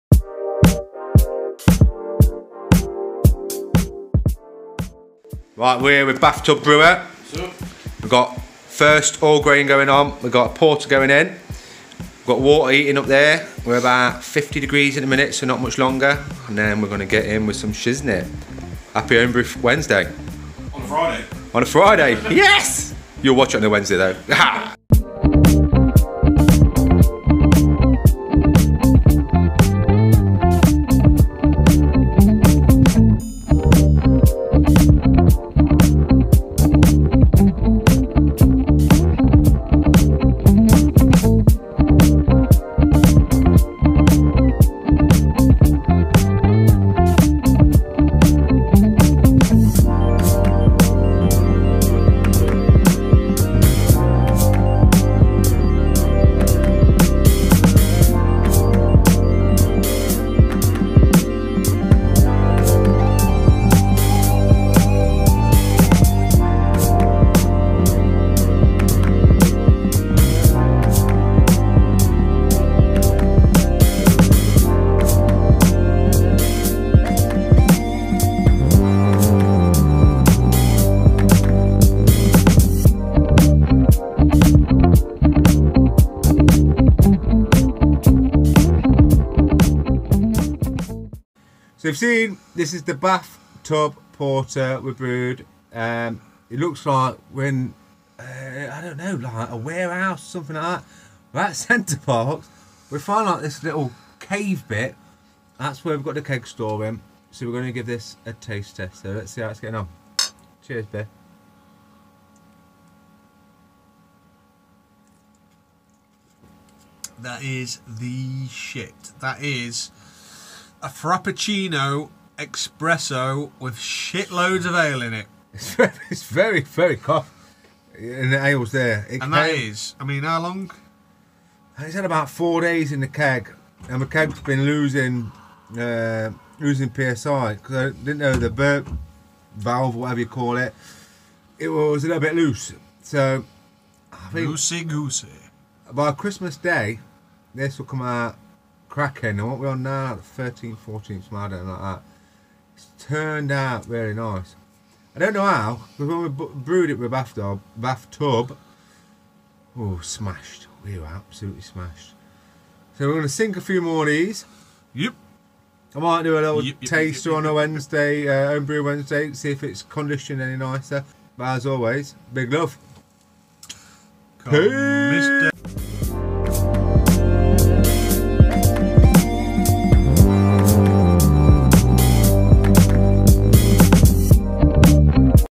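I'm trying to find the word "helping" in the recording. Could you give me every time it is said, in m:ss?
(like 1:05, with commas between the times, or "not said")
not said.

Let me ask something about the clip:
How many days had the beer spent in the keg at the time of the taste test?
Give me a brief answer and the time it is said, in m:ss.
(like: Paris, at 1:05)
4 days, at 2:12.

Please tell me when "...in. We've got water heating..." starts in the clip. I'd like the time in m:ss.
0:11.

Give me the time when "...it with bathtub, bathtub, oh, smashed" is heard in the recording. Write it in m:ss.
2:36.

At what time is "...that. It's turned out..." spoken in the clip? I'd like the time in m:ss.
2:31.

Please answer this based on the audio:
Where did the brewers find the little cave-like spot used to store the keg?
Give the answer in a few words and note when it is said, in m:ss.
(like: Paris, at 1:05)
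Center Parcs, at 1:41.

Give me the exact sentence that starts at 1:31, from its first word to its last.
So you've seen this is the bathtub porter we brewed.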